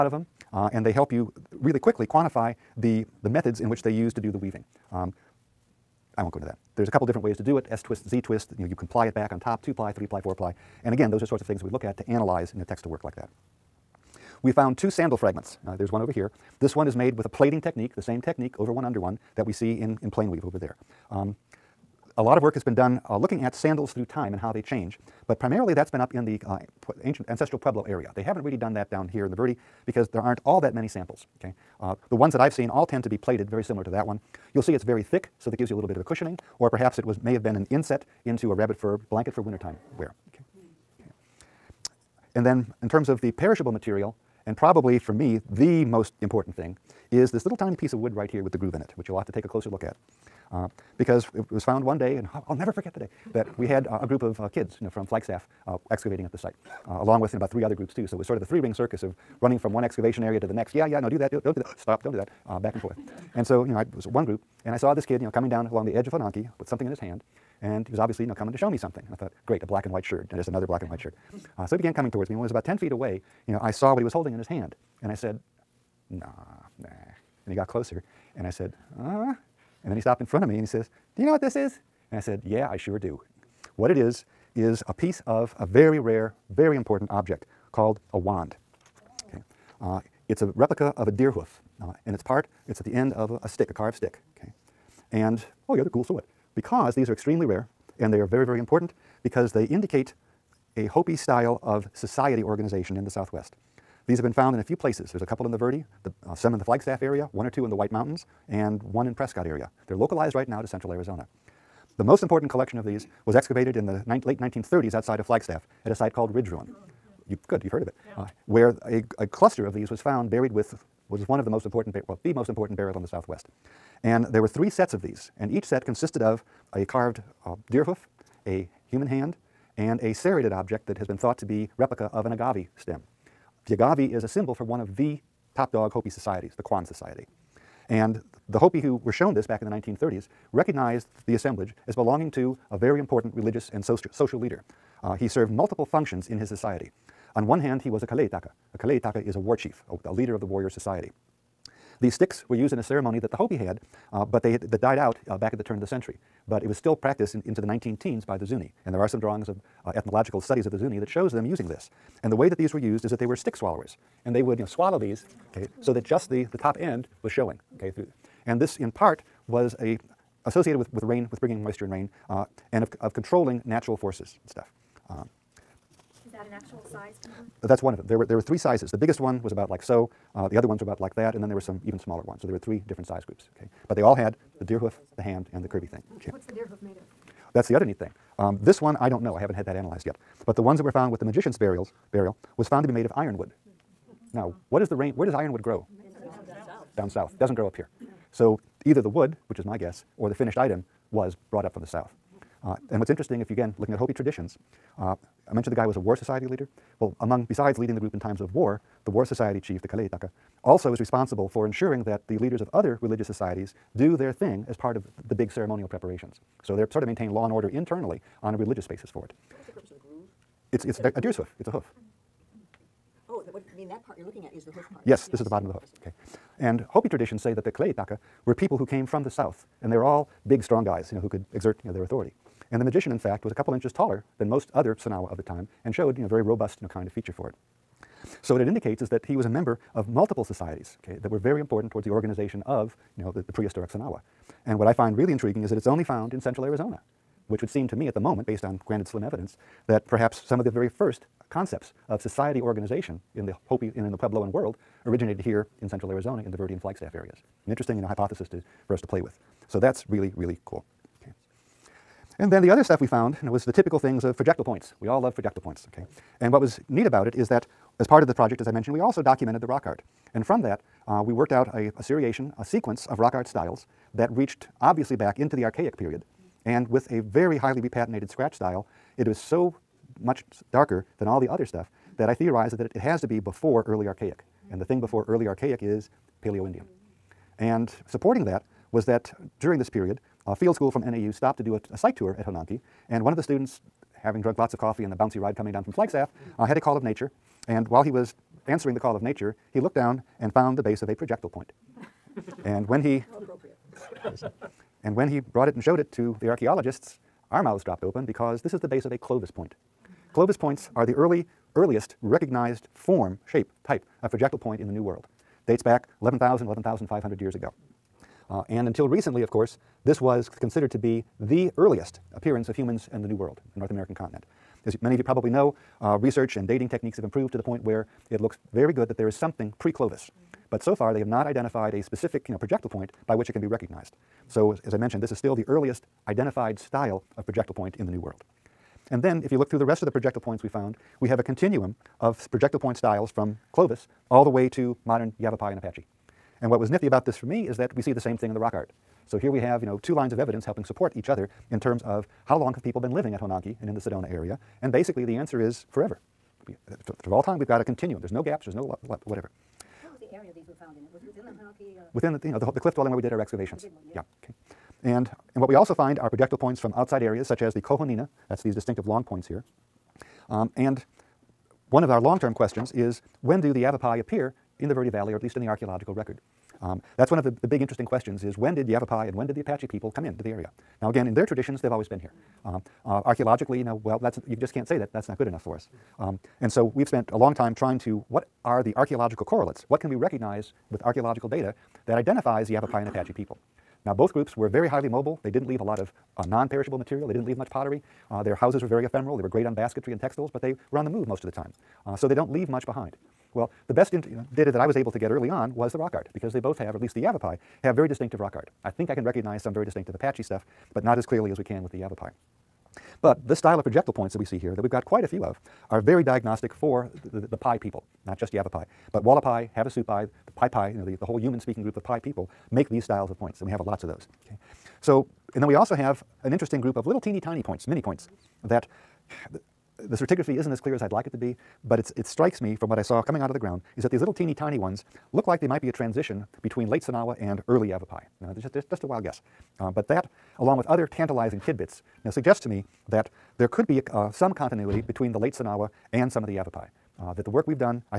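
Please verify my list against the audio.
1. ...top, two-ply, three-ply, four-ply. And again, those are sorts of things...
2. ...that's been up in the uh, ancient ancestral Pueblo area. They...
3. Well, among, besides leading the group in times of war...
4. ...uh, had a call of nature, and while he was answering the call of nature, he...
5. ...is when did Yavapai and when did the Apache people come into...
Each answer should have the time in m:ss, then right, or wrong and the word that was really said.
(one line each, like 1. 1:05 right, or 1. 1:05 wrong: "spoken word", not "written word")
1. 0:09 right
2. 0:25 right
3. 3:26 right
4. 4:56 right
5. 6:18 right.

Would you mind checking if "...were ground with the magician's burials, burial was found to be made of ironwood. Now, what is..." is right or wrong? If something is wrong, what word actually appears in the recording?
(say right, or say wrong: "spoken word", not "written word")
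wrong: "found", not "ground".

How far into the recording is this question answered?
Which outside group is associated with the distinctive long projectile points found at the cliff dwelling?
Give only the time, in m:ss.
6:07.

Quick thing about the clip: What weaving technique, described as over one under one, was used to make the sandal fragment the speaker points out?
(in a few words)
plaiting.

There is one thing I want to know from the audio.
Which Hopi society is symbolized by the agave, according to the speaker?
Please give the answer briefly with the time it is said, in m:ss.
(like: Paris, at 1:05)
Kwan Society, at 2:16.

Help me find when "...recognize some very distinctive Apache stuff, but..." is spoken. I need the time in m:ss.
6:49.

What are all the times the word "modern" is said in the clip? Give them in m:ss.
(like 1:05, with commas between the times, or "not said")
5:45.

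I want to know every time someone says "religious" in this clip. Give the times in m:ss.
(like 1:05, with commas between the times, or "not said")
2:23, 3:33, 3:38.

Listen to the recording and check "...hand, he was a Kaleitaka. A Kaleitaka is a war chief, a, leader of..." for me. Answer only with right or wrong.
right.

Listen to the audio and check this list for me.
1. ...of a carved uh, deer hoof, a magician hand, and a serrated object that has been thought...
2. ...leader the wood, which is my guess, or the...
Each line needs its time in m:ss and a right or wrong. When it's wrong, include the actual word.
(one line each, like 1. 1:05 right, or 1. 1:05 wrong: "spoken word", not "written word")
1. 2:06 wrong: "human", not "magician"
2. 3:18 wrong: "either", not "leader".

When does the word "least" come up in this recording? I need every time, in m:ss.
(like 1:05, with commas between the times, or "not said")
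6:15, 6:46.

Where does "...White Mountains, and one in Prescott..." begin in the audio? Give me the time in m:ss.
1:47.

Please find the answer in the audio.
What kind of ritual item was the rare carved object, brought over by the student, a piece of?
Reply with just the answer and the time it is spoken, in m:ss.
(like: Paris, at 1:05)
wand, at 1:28.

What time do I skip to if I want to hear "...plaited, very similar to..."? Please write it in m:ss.
0:33.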